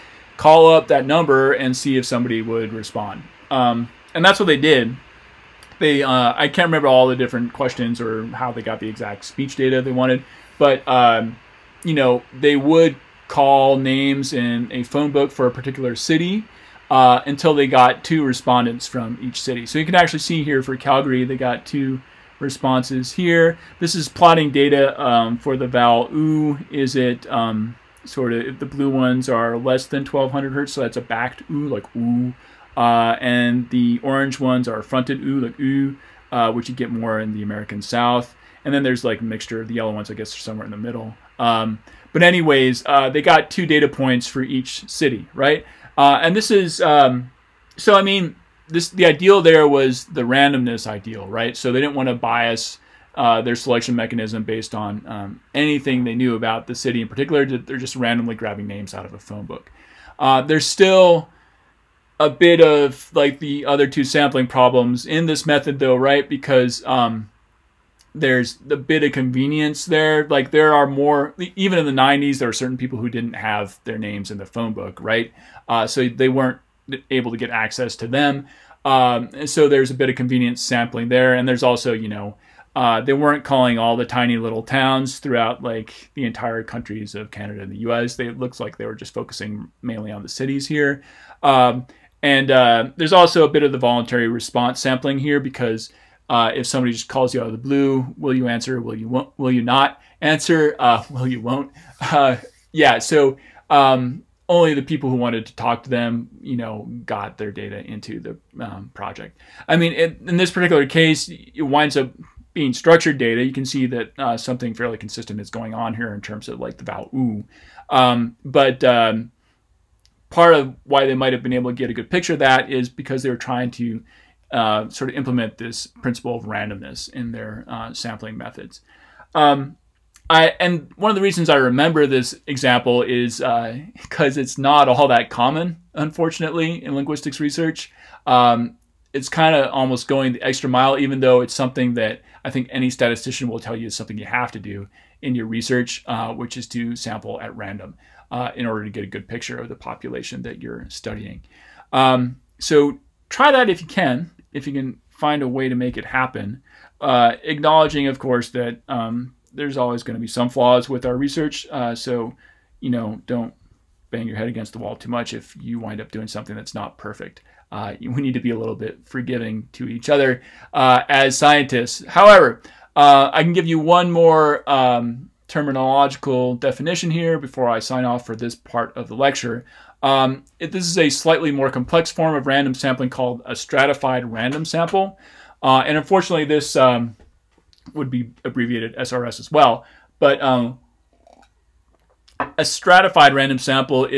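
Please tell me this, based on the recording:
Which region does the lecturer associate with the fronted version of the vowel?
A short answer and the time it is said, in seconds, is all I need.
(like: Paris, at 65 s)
The American South, at 37 s.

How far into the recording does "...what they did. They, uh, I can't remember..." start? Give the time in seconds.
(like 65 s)
4 s.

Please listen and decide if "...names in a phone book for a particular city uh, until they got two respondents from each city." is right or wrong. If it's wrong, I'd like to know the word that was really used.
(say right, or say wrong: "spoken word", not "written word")
right.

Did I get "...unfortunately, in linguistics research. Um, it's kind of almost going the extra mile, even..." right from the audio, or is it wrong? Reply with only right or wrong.
right.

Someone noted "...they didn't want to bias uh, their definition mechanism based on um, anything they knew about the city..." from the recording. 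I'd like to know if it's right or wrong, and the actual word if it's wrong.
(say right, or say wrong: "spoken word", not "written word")
wrong: "selection", not "definition".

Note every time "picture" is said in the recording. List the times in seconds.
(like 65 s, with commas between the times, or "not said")
122 s, 149 s.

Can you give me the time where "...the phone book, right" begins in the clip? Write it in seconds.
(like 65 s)
74 s.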